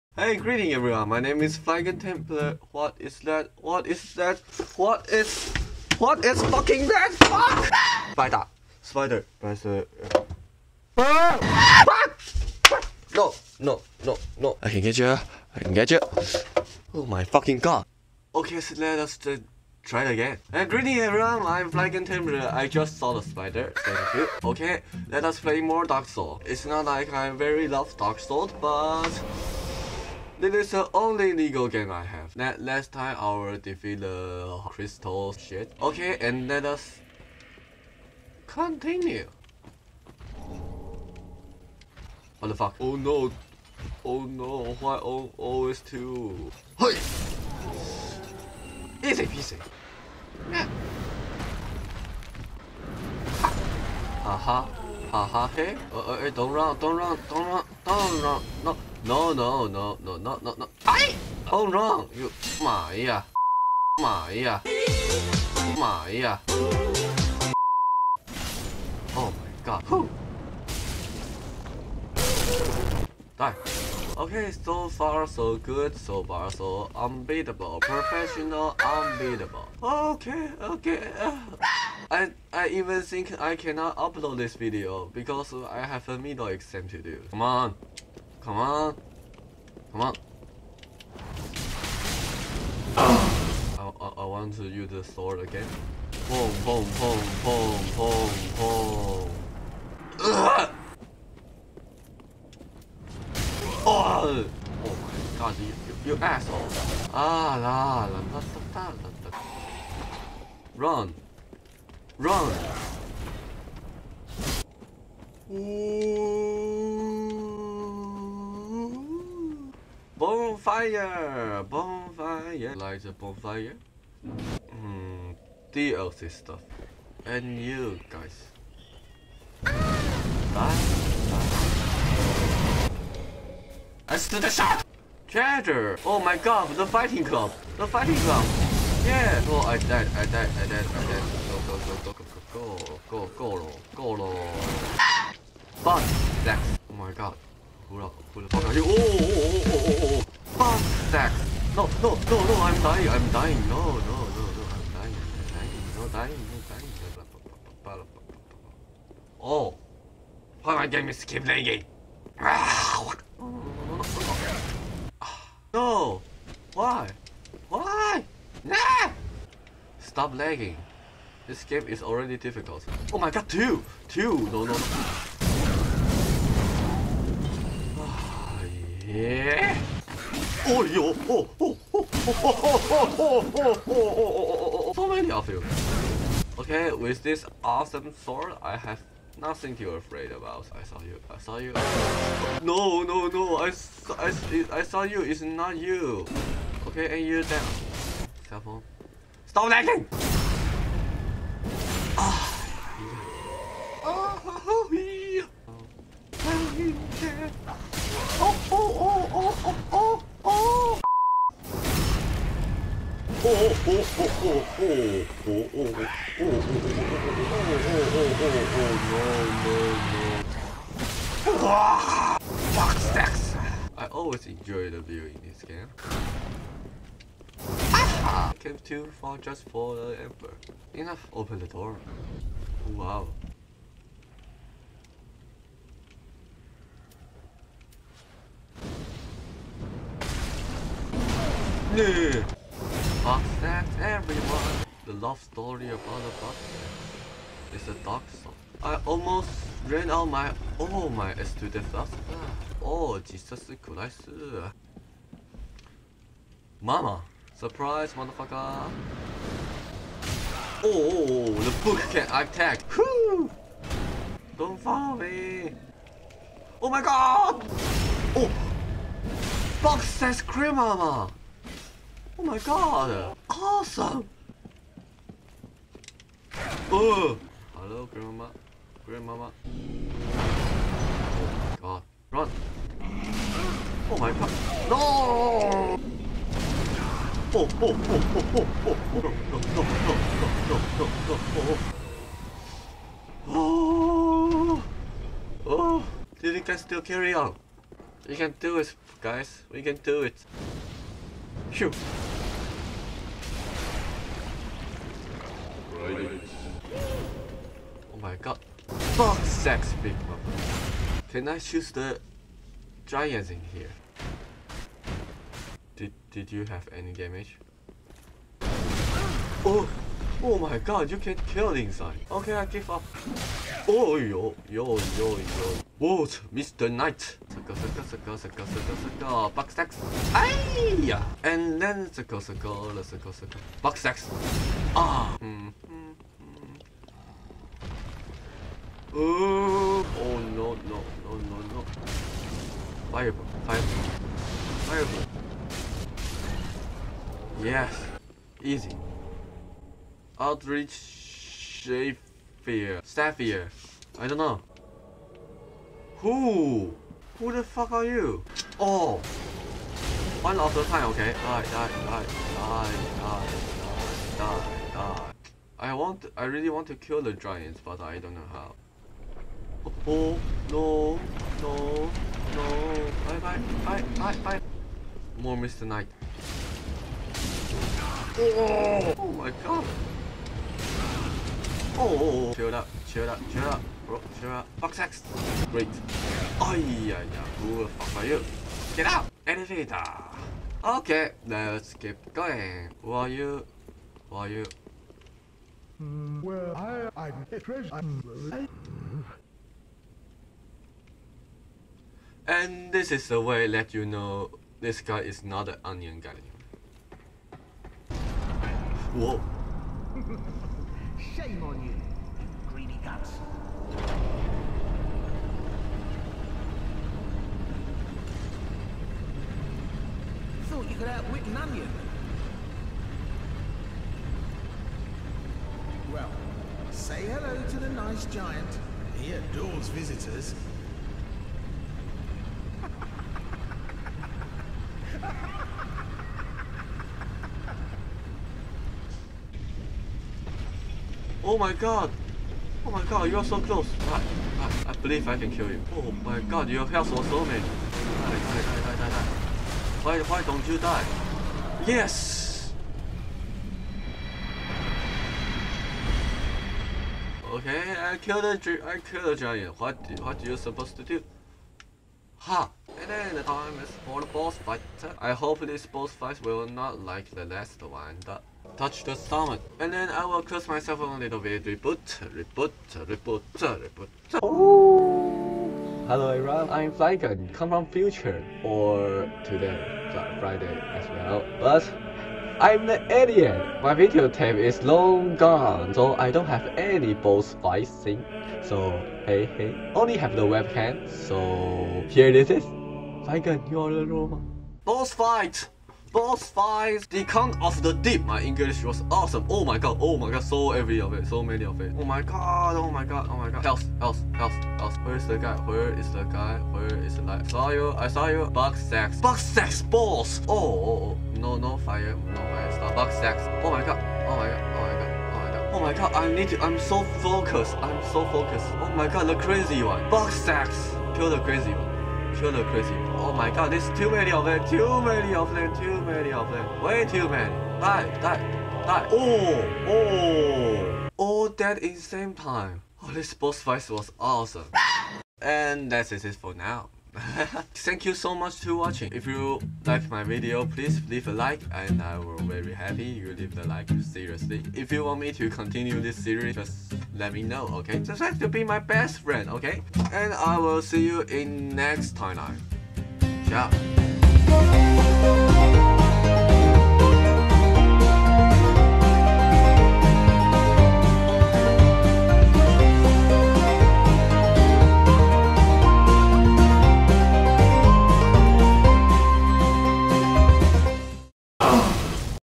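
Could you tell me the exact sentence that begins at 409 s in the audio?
Whoa shame on you, greedy guts.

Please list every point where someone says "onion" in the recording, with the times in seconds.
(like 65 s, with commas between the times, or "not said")
405 s, 421 s.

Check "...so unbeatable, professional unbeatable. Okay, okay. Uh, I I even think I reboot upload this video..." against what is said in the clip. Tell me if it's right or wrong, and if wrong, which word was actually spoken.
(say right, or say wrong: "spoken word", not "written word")
wrong: "cannot", not "reboot".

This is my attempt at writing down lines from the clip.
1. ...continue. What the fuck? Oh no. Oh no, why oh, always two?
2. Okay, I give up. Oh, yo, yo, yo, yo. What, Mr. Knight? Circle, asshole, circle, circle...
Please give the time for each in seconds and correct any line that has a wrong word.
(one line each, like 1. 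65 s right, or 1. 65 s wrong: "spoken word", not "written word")
1. 38 s right
2. 322 s wrong: "circle", not "asshole".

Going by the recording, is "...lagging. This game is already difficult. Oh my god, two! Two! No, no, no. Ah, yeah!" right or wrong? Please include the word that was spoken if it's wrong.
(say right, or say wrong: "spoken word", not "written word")
right.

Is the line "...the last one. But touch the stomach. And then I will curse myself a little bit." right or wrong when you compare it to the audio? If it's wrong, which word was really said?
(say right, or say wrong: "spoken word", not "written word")
right.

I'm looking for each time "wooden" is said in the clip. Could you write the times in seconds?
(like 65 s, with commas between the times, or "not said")
not said.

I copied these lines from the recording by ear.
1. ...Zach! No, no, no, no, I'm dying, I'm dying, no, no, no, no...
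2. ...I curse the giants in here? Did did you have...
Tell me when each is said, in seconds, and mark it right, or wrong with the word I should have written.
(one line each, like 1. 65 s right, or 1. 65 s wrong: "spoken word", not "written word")
1. 151 s right
2. 311 s wrong: "choose", not "curse".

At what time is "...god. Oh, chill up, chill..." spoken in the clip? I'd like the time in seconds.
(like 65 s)
379 s.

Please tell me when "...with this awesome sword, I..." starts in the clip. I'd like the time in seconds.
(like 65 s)
186 s.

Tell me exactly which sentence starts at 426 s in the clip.
Well, say hello to the nice giant.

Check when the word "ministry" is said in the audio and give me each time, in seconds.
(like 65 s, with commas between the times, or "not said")
not said.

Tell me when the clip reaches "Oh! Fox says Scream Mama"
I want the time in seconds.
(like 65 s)
268 s.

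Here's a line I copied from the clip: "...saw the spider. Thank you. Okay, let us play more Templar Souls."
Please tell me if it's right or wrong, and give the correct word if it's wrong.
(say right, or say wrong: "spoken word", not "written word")
wrong: "Dark", not "Templar".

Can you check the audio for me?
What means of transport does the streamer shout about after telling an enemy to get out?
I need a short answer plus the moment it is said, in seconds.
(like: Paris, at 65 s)
Elevator, at 389 s.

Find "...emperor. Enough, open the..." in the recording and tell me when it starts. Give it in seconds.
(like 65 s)
230 s.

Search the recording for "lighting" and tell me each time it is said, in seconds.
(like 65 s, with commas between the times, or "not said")
not said.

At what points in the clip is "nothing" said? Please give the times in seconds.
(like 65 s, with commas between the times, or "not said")
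189 s.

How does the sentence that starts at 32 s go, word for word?
That last time I will defeat the crystal shit.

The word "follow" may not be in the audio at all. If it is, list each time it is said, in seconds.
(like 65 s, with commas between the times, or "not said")
264 s.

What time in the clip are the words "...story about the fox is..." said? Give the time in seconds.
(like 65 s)
245 s.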